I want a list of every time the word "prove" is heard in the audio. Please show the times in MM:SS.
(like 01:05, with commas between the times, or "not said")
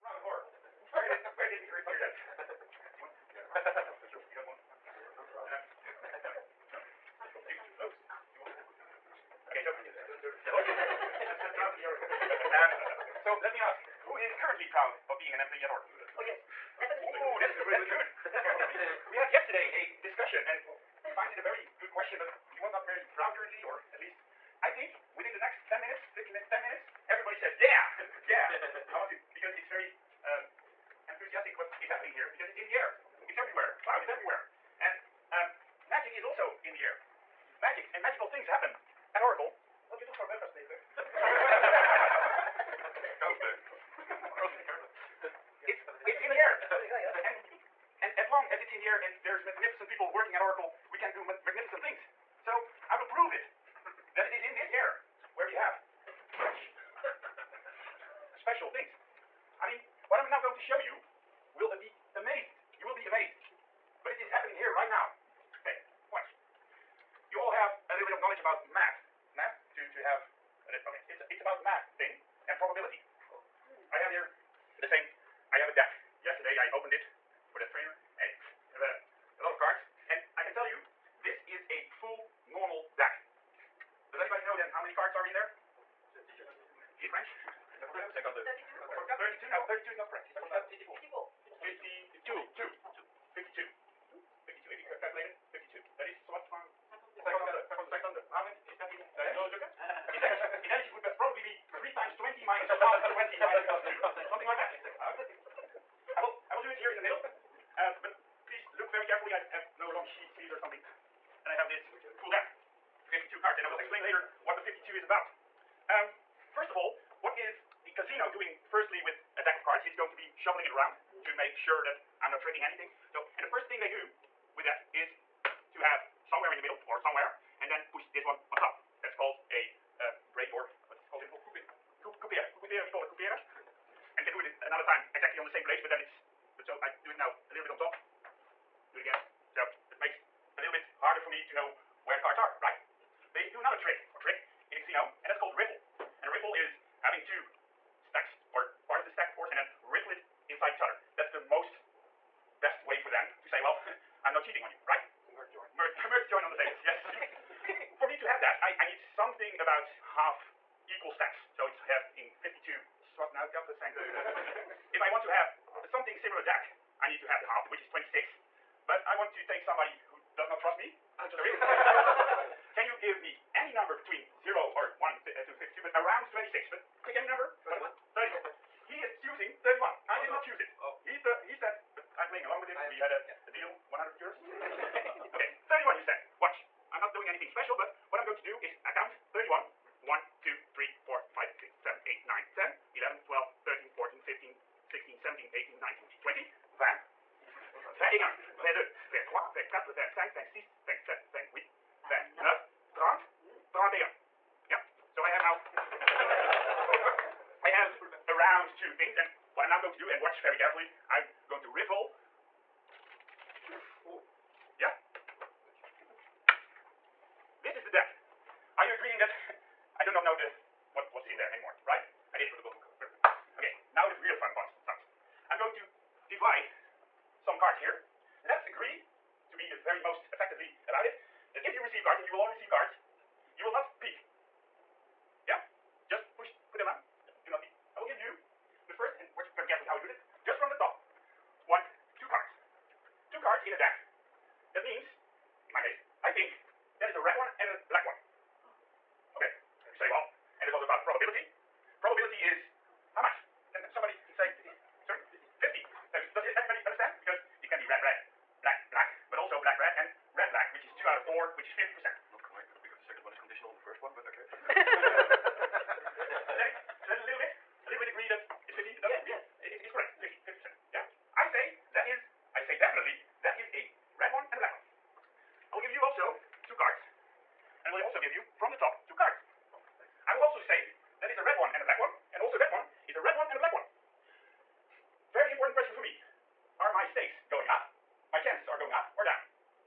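00:53.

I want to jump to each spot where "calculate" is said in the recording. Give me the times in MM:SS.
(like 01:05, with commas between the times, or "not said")
01:35.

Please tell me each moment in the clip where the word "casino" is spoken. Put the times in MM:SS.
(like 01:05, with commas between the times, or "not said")
01:57, 02:24.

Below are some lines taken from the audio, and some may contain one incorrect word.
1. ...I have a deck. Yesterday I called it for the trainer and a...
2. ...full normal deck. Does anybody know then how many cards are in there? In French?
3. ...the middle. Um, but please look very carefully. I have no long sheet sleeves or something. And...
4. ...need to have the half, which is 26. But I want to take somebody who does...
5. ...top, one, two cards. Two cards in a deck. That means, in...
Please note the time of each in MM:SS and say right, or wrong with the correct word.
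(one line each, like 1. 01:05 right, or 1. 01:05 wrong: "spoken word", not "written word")
1. 01:15 wrong: "opened", not "called"
2. 01:21 right
3. 01:46 right
4. 02:47 right
5. 04:00 right.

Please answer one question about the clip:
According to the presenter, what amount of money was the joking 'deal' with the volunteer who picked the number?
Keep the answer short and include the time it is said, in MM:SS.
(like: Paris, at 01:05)
100 euros, at 03:03.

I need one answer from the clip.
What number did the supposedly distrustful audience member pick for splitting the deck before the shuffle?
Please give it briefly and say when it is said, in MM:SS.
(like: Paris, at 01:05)
31, at 02:58.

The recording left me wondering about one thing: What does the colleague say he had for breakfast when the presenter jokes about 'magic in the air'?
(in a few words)
Carlsberg.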